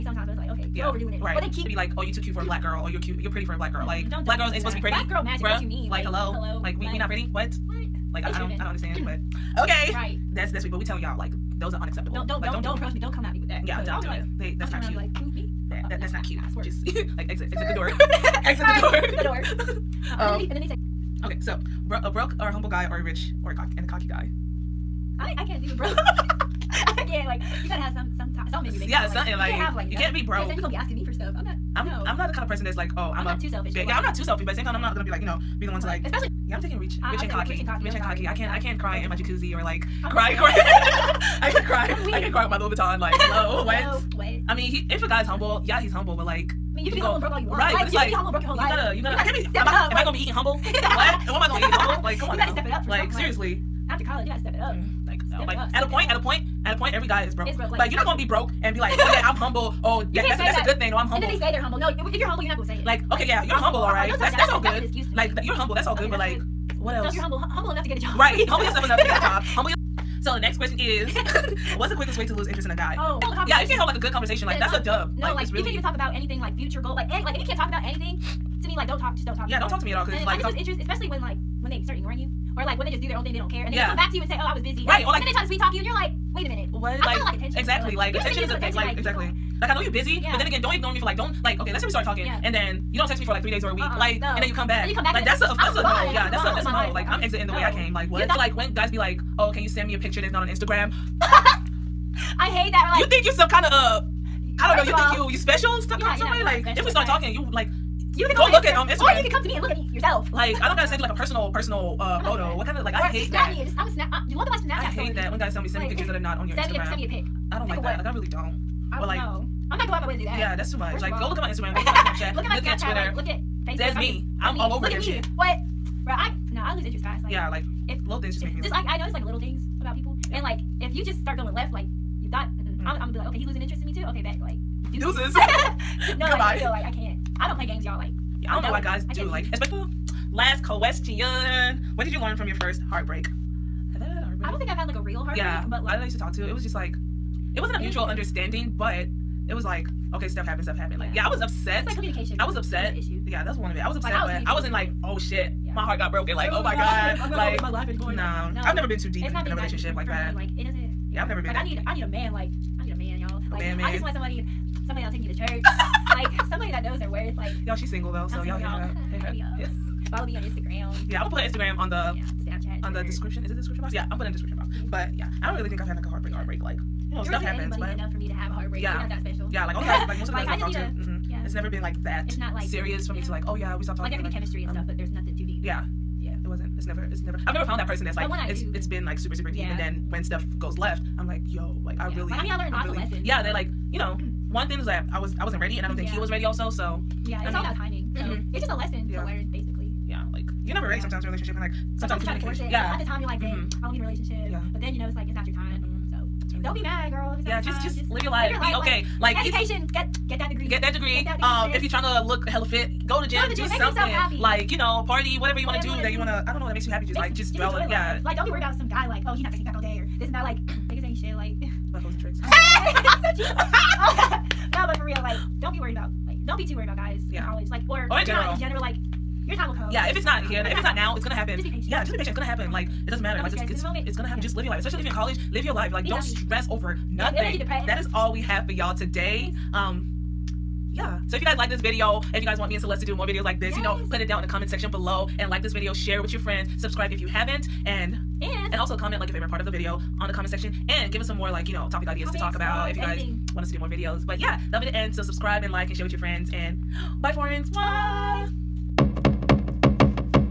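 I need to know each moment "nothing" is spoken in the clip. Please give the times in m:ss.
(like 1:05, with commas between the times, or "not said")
3:05, 3:57.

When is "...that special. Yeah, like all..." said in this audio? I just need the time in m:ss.
2:59.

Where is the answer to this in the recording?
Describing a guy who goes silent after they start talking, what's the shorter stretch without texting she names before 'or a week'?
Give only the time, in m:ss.
1:33.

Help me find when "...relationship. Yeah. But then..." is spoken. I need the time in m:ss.
3:24.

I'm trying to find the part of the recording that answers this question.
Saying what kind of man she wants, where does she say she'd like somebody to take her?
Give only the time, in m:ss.
2:45.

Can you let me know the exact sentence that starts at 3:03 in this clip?
me to like, oh yeah, we stopped talking.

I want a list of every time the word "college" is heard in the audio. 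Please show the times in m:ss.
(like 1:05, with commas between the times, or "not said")
0:54, 3:47, 3:55.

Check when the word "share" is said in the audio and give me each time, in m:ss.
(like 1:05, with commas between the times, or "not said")
4:05, 4:15.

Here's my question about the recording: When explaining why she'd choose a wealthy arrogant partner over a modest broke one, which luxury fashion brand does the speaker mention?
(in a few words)
Louis Vuitton.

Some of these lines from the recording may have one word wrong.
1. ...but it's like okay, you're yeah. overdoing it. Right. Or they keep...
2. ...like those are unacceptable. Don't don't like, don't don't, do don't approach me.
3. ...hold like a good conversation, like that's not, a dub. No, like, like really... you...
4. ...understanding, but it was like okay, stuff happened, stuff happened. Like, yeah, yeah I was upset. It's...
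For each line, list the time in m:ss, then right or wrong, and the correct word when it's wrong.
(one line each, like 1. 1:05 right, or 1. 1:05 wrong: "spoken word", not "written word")
1. 0:00 right
2. 0:11 right
3. 1:13 right
4. 2:28 right.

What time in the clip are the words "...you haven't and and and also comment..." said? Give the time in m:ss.
4:07.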